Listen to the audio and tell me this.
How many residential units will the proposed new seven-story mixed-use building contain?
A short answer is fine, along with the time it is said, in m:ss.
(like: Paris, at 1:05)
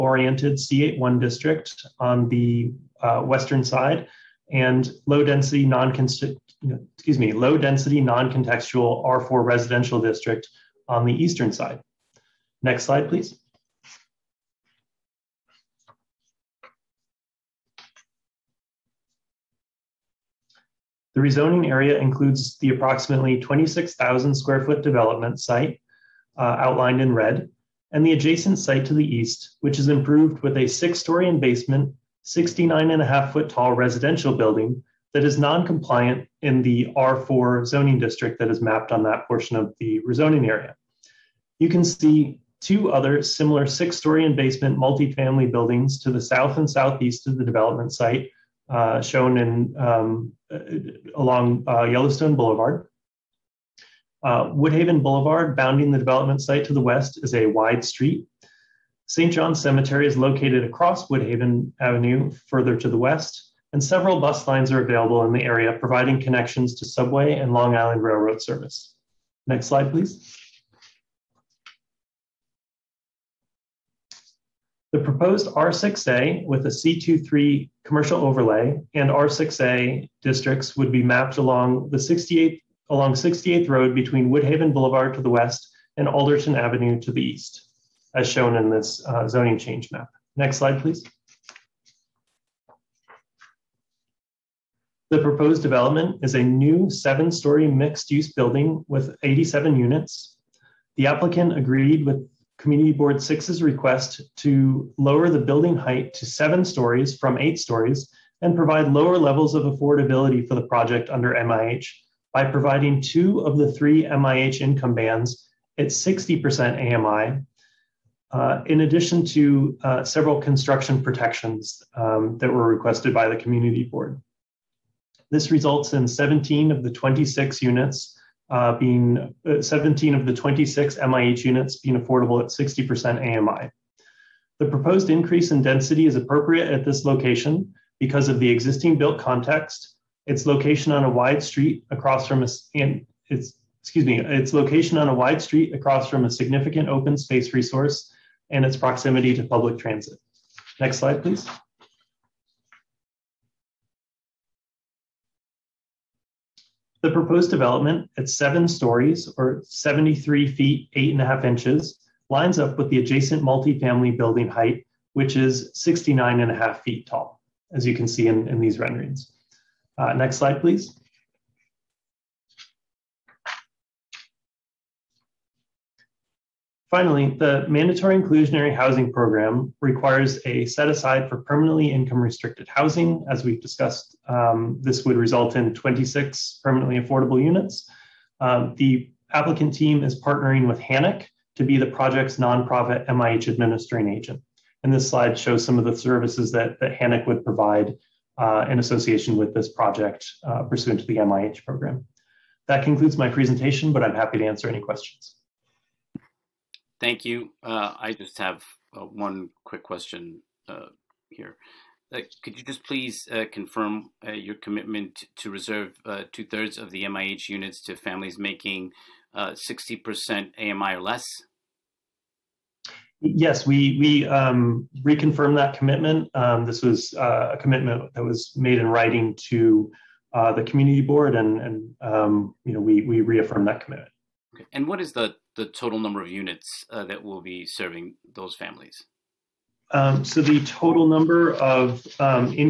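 87, at 1:39.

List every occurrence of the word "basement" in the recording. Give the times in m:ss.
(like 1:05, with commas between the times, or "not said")
0:31, 0:44.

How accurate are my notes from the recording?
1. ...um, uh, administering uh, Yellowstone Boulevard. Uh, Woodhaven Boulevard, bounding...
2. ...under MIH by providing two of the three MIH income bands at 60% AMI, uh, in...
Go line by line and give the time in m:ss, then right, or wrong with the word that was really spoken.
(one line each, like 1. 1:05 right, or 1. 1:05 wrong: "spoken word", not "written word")
1. 0:49 wrong: "along", not "administering"
2. 1:51 right.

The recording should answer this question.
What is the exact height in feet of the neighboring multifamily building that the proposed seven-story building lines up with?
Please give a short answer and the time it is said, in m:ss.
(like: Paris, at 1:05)
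69.5 feet, at 2:45.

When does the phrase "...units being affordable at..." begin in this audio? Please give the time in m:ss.
2:11.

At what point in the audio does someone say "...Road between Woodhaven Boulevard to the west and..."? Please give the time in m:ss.
1:23.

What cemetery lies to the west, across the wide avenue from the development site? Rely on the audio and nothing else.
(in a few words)
St. John's Cemetery.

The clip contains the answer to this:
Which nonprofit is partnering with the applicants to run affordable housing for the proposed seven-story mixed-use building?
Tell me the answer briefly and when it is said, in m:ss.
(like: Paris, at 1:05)
HANAC, at 3:10.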